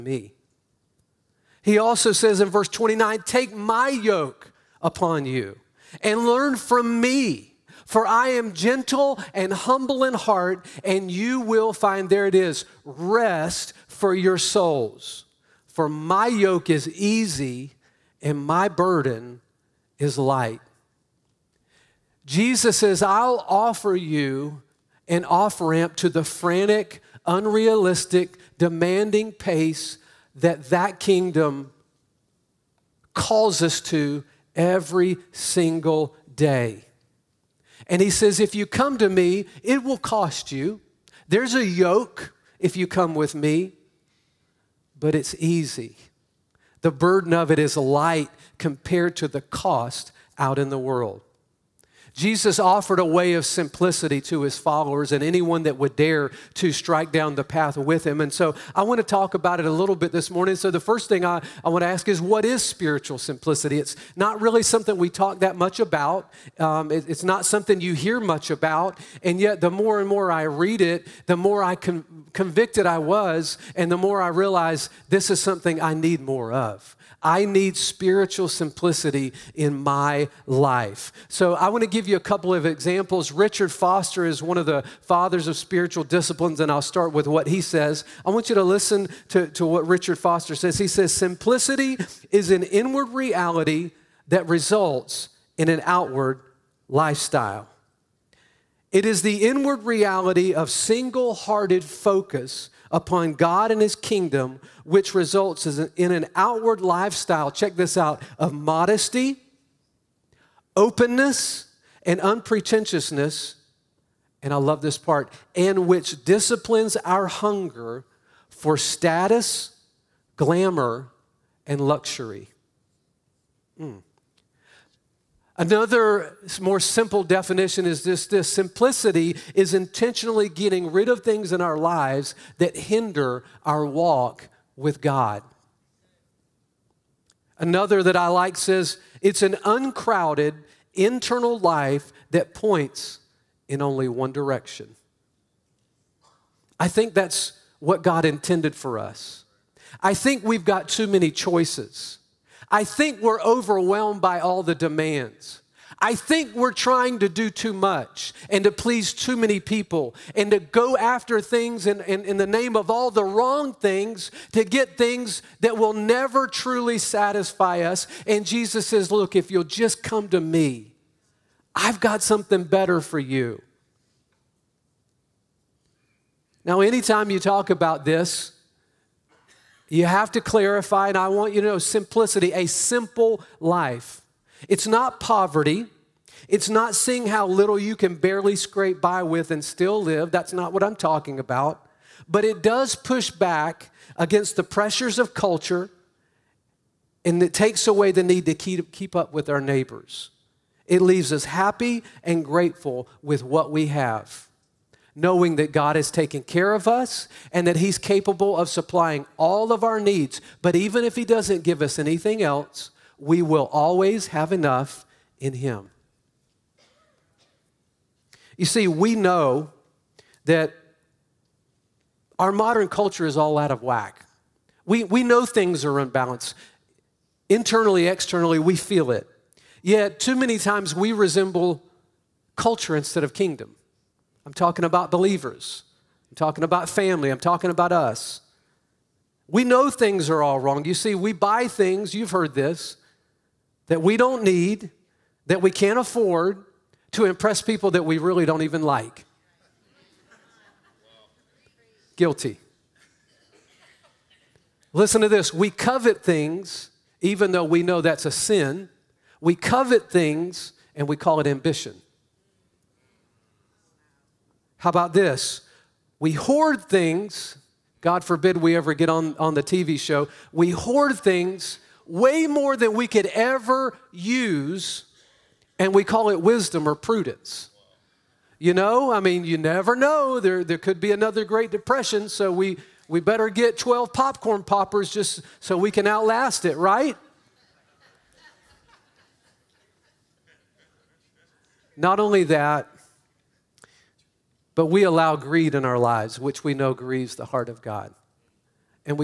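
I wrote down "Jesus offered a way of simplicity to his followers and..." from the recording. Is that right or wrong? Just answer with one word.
right.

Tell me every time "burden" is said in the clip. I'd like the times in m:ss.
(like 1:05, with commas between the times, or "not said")
0:18, 0:46.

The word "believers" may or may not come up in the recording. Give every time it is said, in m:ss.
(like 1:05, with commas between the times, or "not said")
3:55.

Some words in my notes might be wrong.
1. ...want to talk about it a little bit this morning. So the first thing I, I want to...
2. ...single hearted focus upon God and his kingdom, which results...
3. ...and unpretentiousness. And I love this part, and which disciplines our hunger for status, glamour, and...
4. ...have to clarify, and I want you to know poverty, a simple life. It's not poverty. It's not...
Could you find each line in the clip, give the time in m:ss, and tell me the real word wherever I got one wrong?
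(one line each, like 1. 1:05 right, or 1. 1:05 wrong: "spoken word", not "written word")
1. 0:58 right
2. 1:40 right
3. 1:52 right
4. 3:00 wrong: "simplicity", not "poverty".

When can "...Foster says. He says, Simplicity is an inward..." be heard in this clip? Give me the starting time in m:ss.
1:30.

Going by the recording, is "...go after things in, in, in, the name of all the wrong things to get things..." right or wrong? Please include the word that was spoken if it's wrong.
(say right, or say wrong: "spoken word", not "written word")
right.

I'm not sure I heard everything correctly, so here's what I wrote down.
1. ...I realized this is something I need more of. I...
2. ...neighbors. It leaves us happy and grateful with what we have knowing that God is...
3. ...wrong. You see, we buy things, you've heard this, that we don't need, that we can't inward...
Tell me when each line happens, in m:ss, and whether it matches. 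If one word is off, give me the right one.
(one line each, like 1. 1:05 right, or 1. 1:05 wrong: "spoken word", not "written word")
1. 1:14 right
2. 3:19 right
3. 4:00 wrong: "afford", not "inward".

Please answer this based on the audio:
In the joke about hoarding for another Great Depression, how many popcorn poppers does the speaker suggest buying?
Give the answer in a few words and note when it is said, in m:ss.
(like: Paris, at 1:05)
12, at 4:43.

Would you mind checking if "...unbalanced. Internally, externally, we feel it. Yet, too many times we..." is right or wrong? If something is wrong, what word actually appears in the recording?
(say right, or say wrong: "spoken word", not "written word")
right.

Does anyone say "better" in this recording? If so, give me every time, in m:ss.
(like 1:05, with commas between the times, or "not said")
2:52, 4:43.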